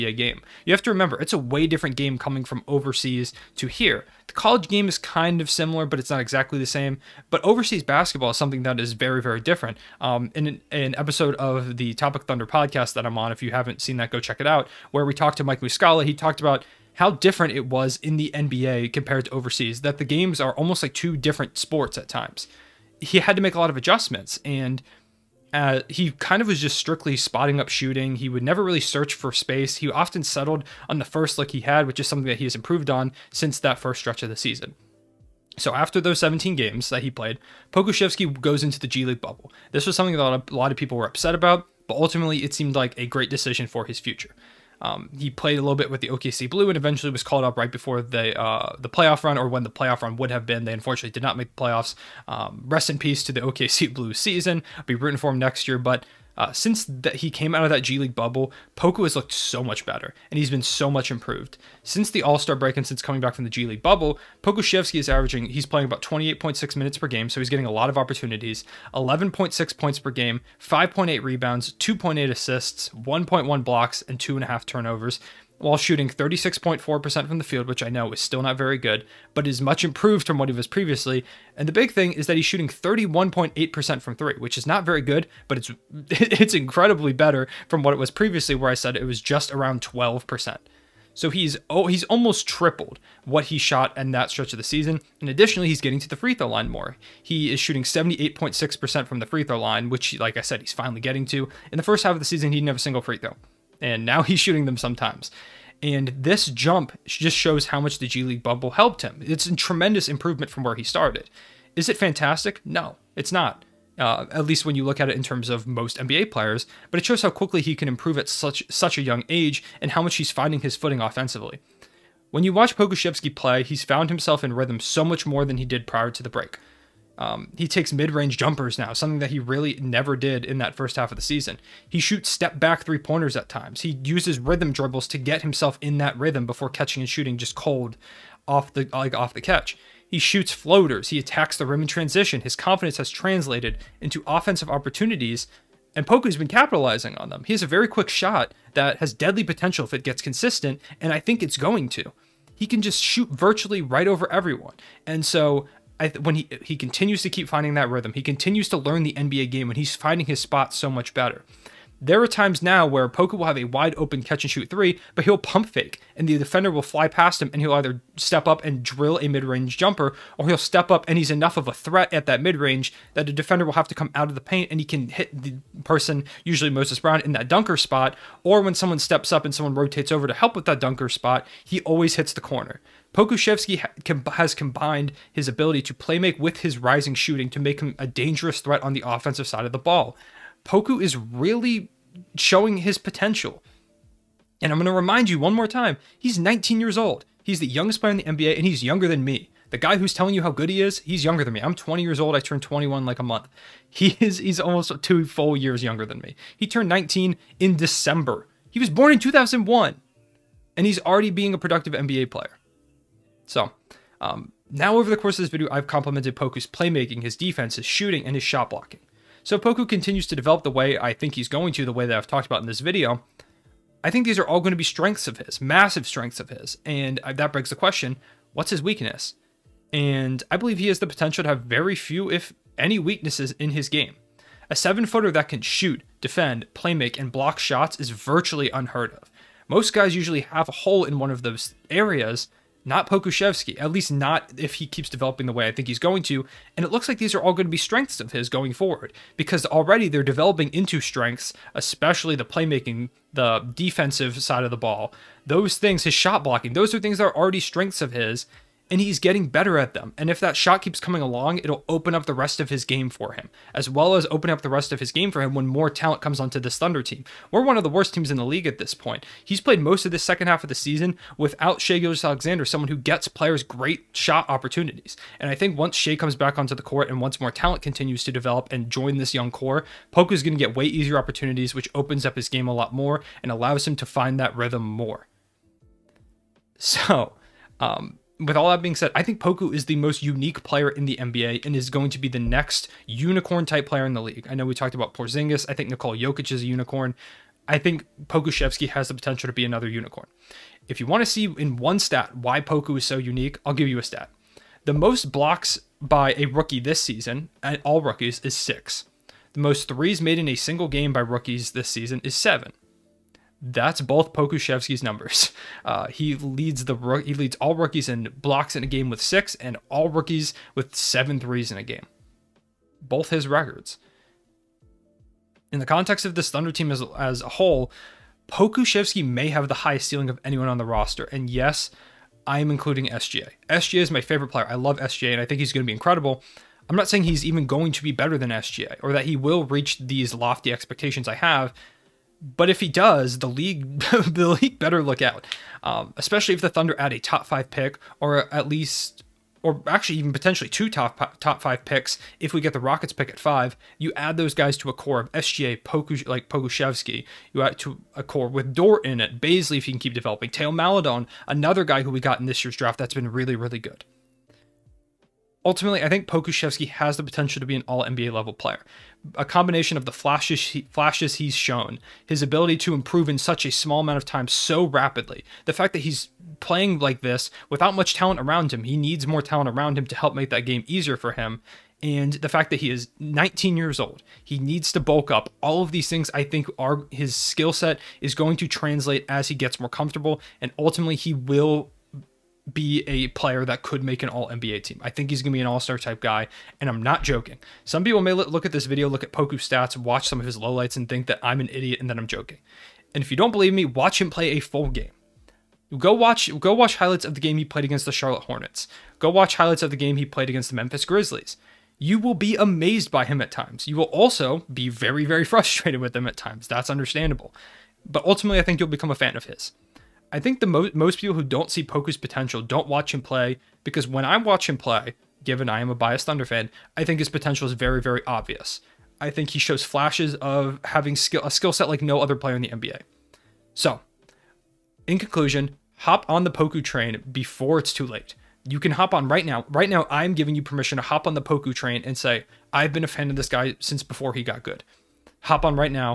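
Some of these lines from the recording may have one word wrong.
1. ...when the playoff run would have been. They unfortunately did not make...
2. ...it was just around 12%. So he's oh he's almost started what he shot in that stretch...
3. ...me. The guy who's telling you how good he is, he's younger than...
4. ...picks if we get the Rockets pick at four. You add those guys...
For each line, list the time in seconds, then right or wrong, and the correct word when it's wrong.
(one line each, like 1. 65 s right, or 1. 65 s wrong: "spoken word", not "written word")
1. 49 s right
2. 88 s wrong: "tripled", not "started"
3. 199 s right
4. 351 s wrong: "five", not "four".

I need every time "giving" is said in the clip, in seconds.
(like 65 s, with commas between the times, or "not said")
440 s.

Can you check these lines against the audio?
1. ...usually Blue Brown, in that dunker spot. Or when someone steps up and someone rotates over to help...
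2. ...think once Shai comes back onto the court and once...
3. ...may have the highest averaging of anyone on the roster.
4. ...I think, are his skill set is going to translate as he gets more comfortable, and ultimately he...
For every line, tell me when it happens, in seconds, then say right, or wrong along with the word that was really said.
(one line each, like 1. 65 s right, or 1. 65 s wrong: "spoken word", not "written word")
1. 176 s wrong: "Moses", not "Blue"
2. 275 s right
3. 329 s wrong: "ceiling", not "averaging"
4. 386 s right.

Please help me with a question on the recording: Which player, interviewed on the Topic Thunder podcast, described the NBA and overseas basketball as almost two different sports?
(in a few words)
Mike Muscala.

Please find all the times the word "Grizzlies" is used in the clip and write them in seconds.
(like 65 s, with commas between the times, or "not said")
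411 s.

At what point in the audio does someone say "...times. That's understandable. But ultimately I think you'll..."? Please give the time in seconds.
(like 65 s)
416 s.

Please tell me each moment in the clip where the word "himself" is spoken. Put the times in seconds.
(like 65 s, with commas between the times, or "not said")
124 s, 135 s.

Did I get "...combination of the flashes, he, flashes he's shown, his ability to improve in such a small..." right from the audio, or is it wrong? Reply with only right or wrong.
right.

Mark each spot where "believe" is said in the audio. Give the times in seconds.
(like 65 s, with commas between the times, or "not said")
230 s, 403 s.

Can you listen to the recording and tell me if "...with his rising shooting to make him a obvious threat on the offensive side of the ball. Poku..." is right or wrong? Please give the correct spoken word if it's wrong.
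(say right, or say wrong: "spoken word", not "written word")
wrong: "dangerous", not "obvious".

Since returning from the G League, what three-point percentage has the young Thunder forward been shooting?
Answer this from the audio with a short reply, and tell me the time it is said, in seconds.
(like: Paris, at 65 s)
31.8%, at 82 s.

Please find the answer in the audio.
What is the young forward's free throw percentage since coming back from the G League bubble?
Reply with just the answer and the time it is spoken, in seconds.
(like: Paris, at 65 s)
78.6%, at 97 s.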